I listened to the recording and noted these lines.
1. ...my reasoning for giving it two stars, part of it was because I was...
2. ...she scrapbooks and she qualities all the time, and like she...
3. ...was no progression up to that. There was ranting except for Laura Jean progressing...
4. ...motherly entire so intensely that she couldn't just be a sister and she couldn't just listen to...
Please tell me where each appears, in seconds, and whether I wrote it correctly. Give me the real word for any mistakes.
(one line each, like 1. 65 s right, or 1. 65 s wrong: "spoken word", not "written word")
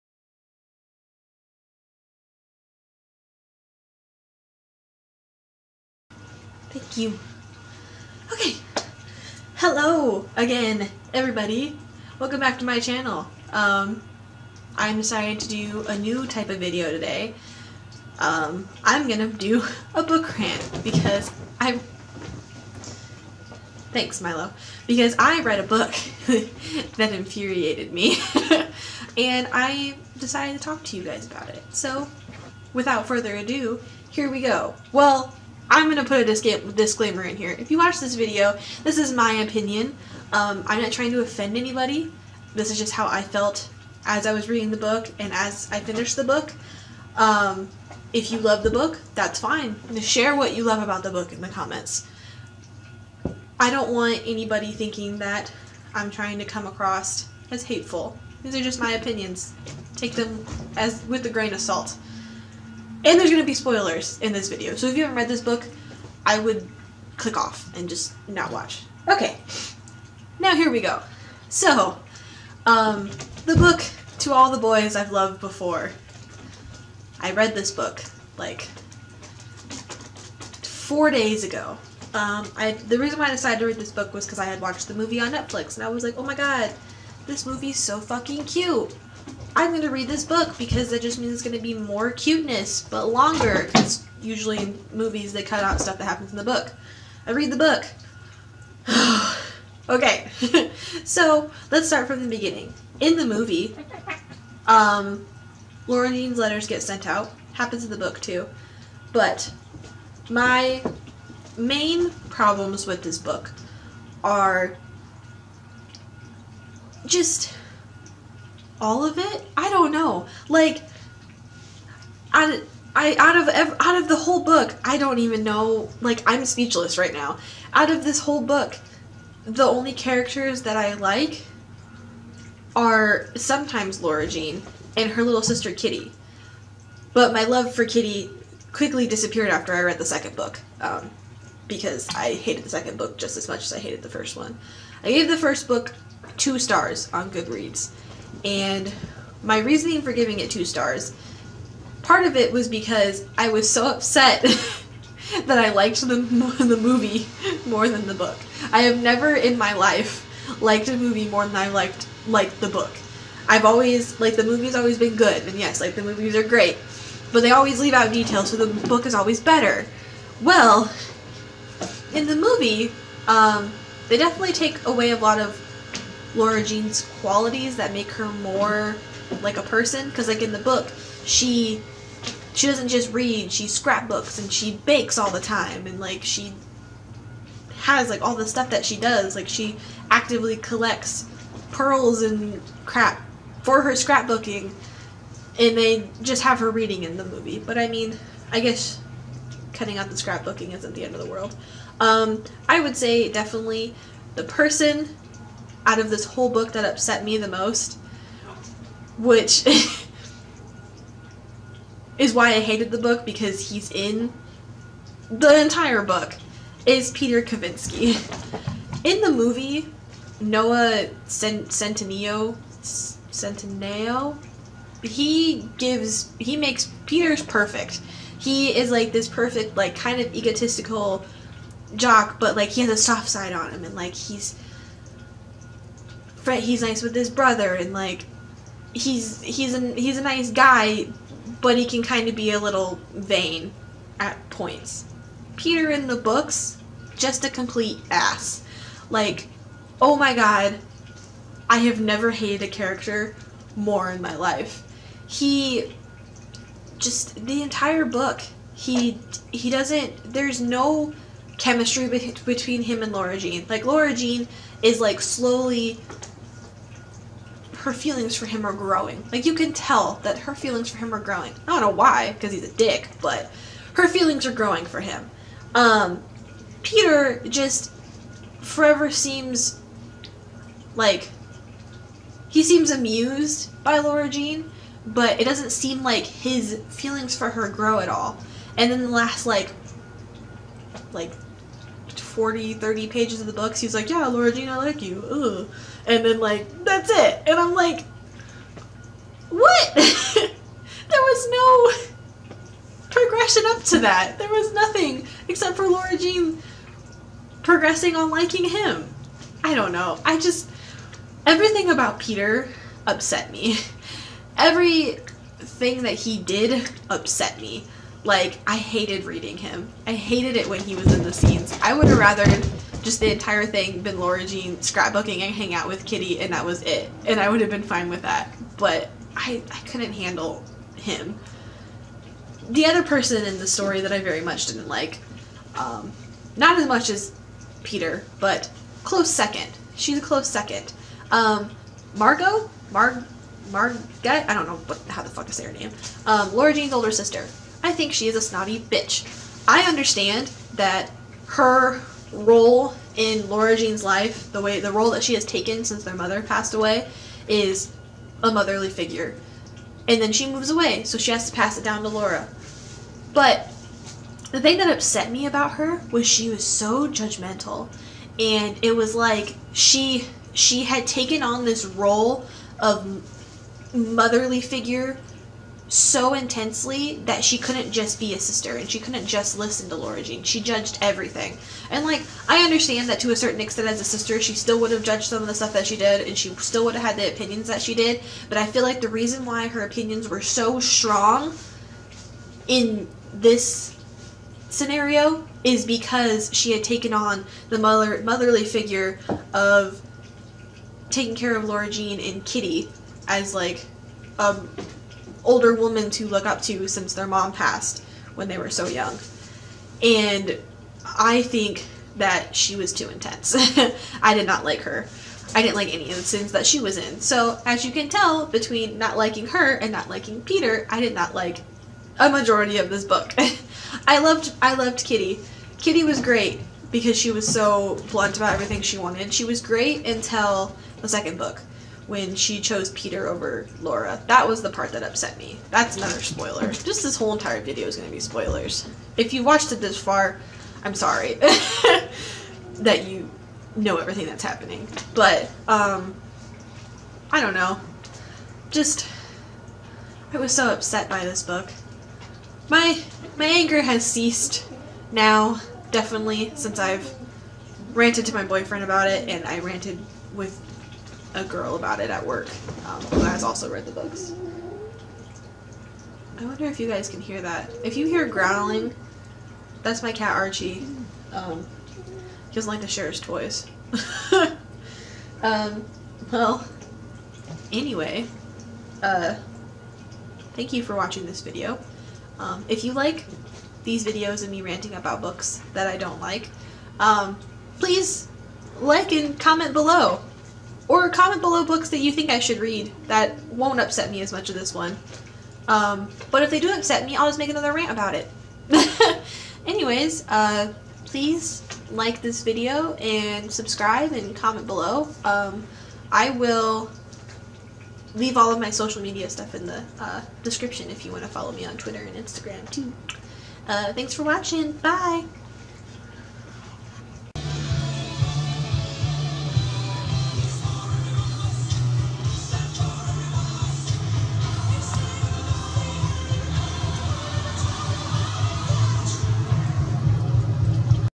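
1. 149 s right
2. 183 s wrong: "bakes", not "qualities"
3. 301 s wrong: "nothing", not "ranting"
4. 373 s wrong: "figure", not "entire".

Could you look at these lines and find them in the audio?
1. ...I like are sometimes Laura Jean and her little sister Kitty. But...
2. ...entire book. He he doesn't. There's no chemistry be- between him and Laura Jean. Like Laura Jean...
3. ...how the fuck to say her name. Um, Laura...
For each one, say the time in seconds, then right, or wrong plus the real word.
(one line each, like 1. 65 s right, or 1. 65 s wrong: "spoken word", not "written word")
1. 130 s right
2. 257 s right
3. 345 s right.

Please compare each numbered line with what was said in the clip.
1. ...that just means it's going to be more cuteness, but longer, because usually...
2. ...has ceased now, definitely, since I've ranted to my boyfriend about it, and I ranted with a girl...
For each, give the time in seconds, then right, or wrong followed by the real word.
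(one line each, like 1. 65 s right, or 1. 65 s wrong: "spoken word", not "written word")
1. 90 s right
2. 453 s right.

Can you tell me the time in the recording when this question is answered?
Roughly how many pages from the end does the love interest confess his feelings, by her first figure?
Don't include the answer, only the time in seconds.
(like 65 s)
292 s.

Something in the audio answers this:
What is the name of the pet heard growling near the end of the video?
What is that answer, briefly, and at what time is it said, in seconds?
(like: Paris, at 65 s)
Archie, at 470 s.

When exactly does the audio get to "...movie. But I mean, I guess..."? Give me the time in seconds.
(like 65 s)
197 s.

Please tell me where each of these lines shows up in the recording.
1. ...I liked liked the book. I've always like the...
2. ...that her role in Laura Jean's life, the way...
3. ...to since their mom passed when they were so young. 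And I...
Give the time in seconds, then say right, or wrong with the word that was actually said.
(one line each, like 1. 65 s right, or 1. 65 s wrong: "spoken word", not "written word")
1. 161 s right
2. 350 s right
3. 406 s right.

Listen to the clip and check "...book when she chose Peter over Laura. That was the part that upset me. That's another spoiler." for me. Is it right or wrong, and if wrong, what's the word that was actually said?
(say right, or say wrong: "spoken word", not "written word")
right.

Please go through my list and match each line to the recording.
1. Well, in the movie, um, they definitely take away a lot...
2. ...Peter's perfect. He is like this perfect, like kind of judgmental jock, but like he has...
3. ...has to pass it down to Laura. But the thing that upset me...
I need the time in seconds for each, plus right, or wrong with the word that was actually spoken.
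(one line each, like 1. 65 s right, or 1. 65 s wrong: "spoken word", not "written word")
1. 170 s right
2. 227 s wrong: "egotistical", not "judgmental"
3. 361 s right.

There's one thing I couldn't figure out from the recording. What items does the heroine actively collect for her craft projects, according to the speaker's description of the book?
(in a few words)
Pearls.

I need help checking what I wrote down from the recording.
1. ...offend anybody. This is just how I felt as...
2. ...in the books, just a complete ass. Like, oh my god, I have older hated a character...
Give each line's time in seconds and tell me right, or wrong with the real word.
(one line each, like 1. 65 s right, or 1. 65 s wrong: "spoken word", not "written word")
1. 41 s right
2. 245 s wrong: "never", not "older".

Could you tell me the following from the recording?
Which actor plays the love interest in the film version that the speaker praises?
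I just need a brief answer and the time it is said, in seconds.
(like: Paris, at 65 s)
Noah Centineo, at 220 s.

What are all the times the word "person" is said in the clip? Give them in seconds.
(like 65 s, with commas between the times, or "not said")
179 s, 204 s, 333 s.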